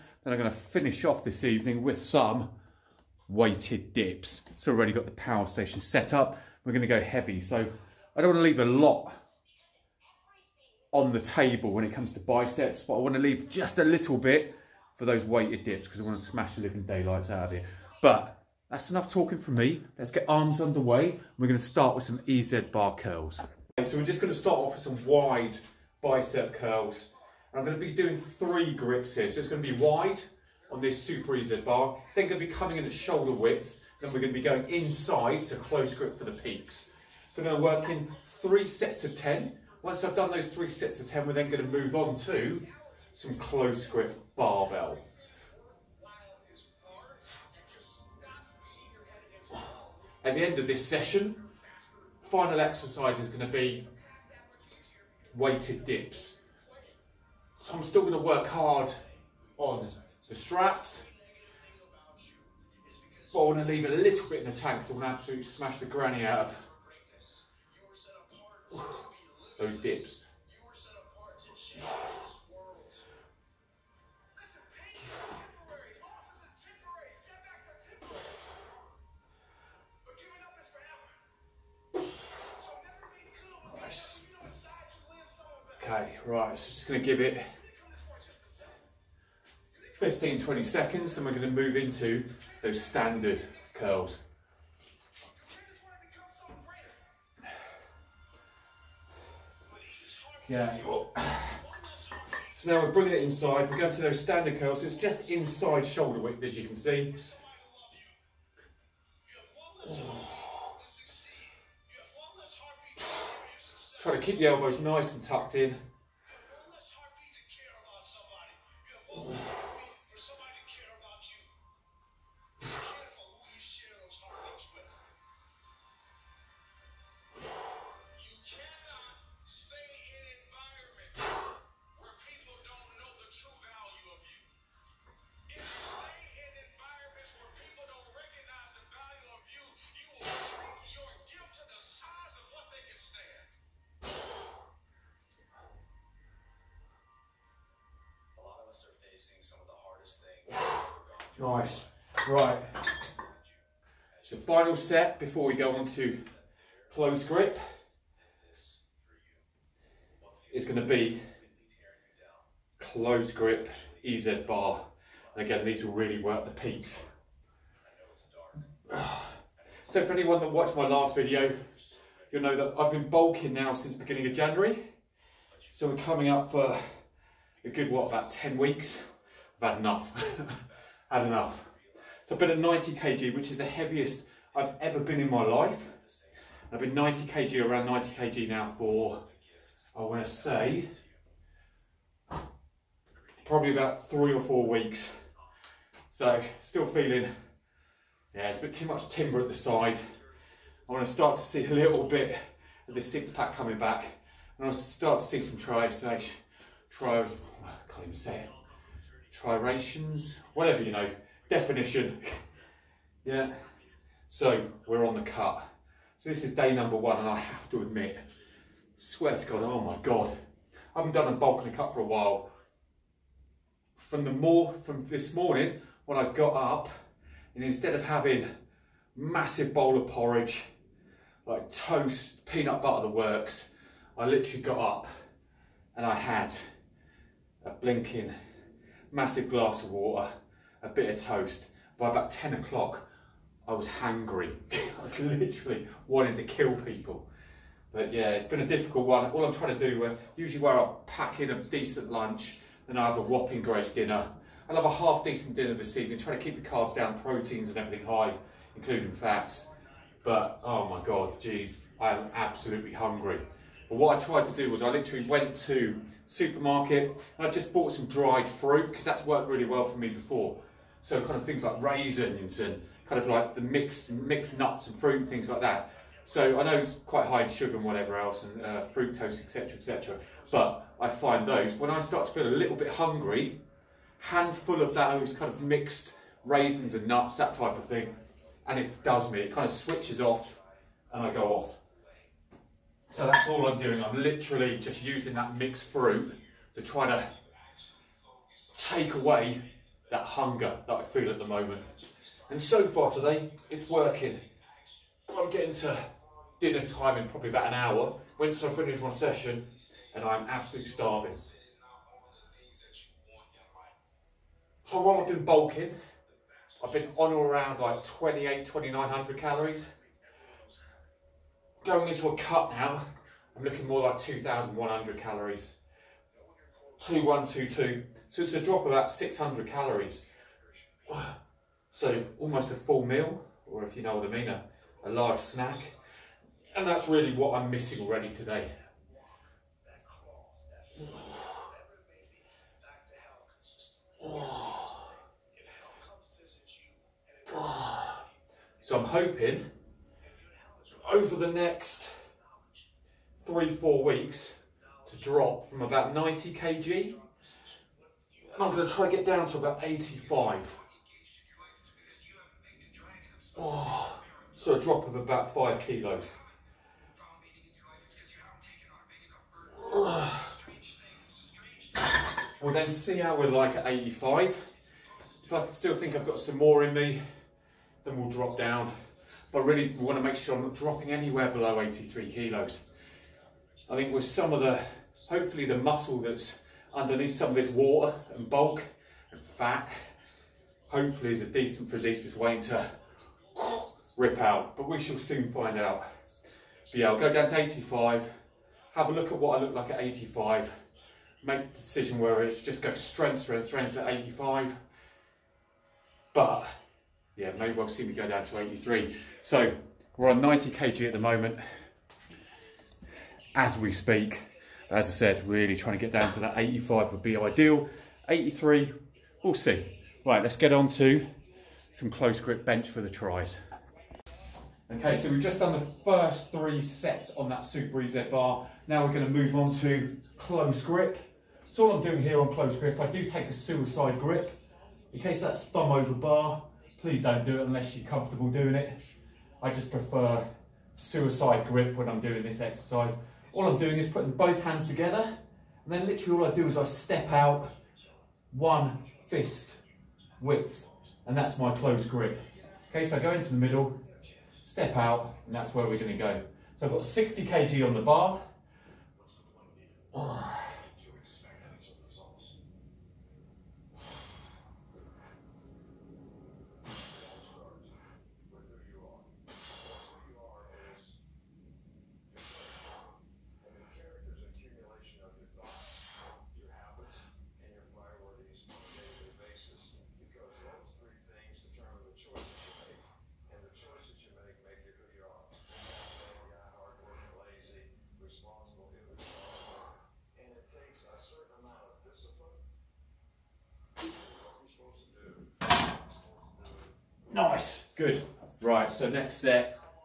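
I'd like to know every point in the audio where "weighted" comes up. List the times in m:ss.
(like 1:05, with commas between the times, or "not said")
0:03, 0:15, 0:55.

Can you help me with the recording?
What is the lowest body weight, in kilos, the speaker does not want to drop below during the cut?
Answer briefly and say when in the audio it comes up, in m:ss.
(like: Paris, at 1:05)
83 kilos, at 6:21.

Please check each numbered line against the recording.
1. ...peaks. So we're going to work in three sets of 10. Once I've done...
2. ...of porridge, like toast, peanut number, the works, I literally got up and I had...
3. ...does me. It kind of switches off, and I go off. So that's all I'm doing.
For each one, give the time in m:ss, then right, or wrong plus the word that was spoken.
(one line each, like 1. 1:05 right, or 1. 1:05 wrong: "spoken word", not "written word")
1. 0:36 right
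2. 3:50 wrong: "butter", not "number"
3. 4:49 right.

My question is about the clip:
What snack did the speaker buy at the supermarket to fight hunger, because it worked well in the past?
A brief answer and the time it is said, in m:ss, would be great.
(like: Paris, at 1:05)
dried fruit, at 4:28.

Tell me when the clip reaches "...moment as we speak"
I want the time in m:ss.
6:51.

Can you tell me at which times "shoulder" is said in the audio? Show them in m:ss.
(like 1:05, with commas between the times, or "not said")
0:32, 1:45.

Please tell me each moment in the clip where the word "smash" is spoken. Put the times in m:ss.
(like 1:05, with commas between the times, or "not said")
0:16, 1:05.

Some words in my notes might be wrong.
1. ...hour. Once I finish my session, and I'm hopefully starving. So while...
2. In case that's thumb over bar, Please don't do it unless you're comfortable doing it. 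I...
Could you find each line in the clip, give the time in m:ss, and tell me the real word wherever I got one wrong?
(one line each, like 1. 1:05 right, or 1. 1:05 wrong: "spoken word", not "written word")
1. 5:07 wrong: "absolutely", not "hopefully"
2. 7:15 right.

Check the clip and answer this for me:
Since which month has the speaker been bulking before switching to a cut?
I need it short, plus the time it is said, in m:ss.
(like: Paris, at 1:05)
January, at 2:54.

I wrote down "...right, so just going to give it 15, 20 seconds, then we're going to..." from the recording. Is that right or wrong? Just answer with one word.
right.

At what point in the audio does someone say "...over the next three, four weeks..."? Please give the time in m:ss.
5:51.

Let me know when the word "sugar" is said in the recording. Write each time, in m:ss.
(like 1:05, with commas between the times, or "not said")
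4:37.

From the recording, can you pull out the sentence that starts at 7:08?
Now we're gonna move on to close grip.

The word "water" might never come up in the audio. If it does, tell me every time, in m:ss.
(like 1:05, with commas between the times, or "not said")
3:59, 6:27.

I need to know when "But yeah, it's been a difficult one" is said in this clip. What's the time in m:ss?
4:07.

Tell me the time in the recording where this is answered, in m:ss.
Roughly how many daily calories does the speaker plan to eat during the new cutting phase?
5:24.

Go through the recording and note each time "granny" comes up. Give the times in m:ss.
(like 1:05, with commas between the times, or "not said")
1:05.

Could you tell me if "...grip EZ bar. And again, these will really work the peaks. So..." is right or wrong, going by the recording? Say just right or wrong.
right.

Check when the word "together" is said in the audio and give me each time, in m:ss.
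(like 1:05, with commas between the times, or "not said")
7:24.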